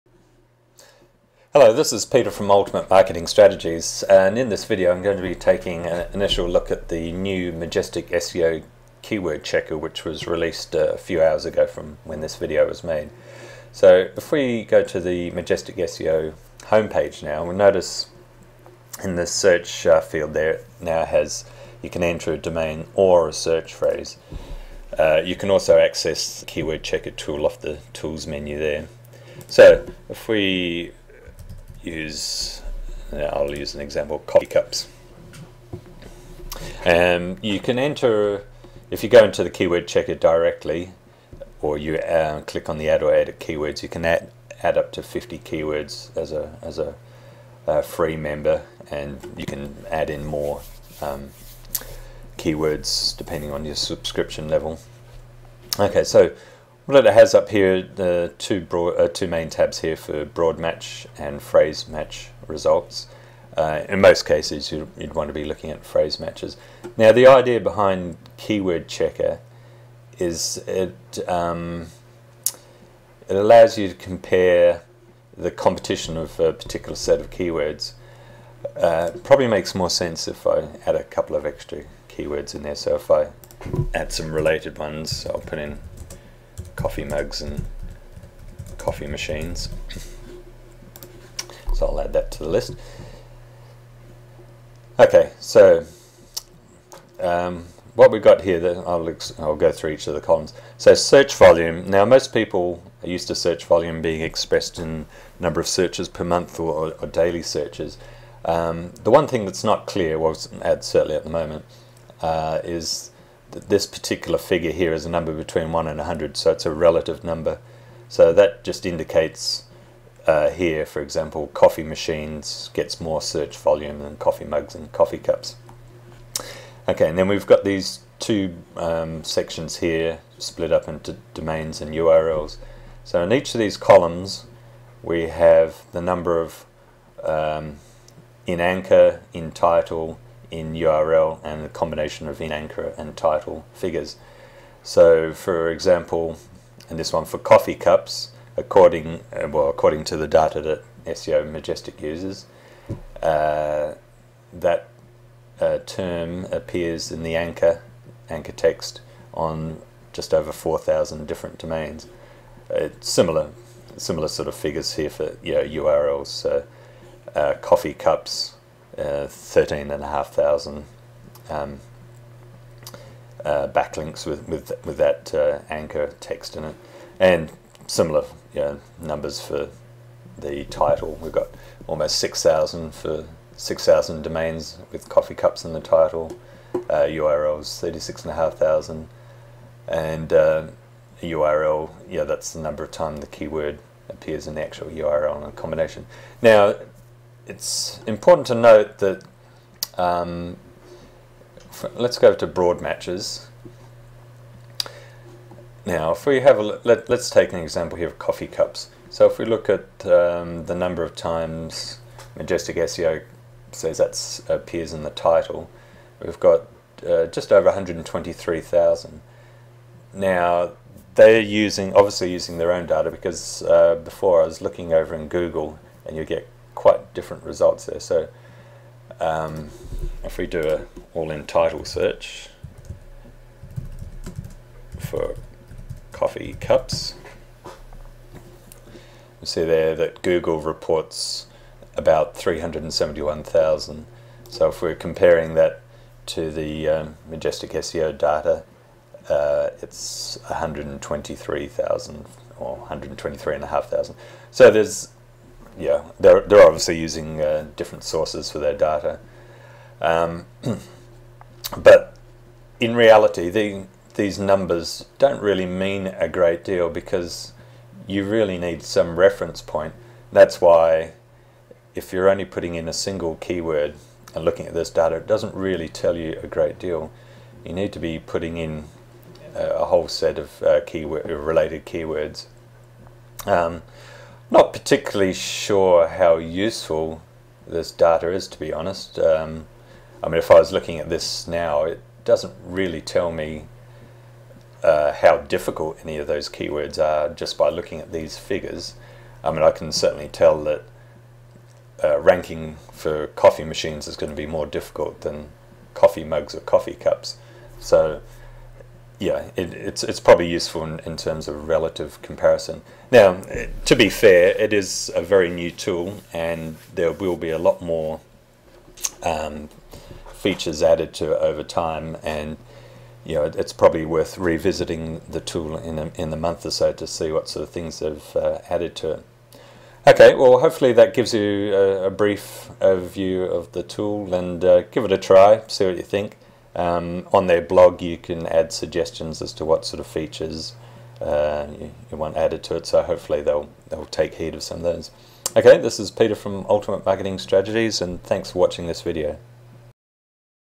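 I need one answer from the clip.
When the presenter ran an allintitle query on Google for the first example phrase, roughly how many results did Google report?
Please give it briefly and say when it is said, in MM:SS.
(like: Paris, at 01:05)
371,000, at 04:02.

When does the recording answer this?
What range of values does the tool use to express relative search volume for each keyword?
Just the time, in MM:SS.
01:55.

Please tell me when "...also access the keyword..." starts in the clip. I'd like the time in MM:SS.
00:25.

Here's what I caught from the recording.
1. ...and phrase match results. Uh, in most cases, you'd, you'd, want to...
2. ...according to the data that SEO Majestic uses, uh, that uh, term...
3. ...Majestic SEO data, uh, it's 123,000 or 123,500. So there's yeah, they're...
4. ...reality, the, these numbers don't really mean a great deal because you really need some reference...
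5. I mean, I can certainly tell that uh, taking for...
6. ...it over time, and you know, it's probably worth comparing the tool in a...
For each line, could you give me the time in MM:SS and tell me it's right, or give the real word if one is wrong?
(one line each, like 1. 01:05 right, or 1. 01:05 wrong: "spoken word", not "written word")
1. 01:01 right
2. 02:29 right
3. 04:07 right
4. 04:22 right
5. 04:59 wrong: "ranking", not "taking"
6. 05:21 wrong: "revisiting", not "comparing".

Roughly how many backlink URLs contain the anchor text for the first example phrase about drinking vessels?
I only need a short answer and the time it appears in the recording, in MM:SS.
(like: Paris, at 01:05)
13,500, at 02:49.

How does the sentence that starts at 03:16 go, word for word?
Now, it's important to note that um, let's go to broad matches.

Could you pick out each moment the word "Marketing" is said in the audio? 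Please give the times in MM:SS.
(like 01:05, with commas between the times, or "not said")
00:02, 05:47.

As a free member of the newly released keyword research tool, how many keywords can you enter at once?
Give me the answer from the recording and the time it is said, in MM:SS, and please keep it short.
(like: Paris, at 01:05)
50, at 00:45.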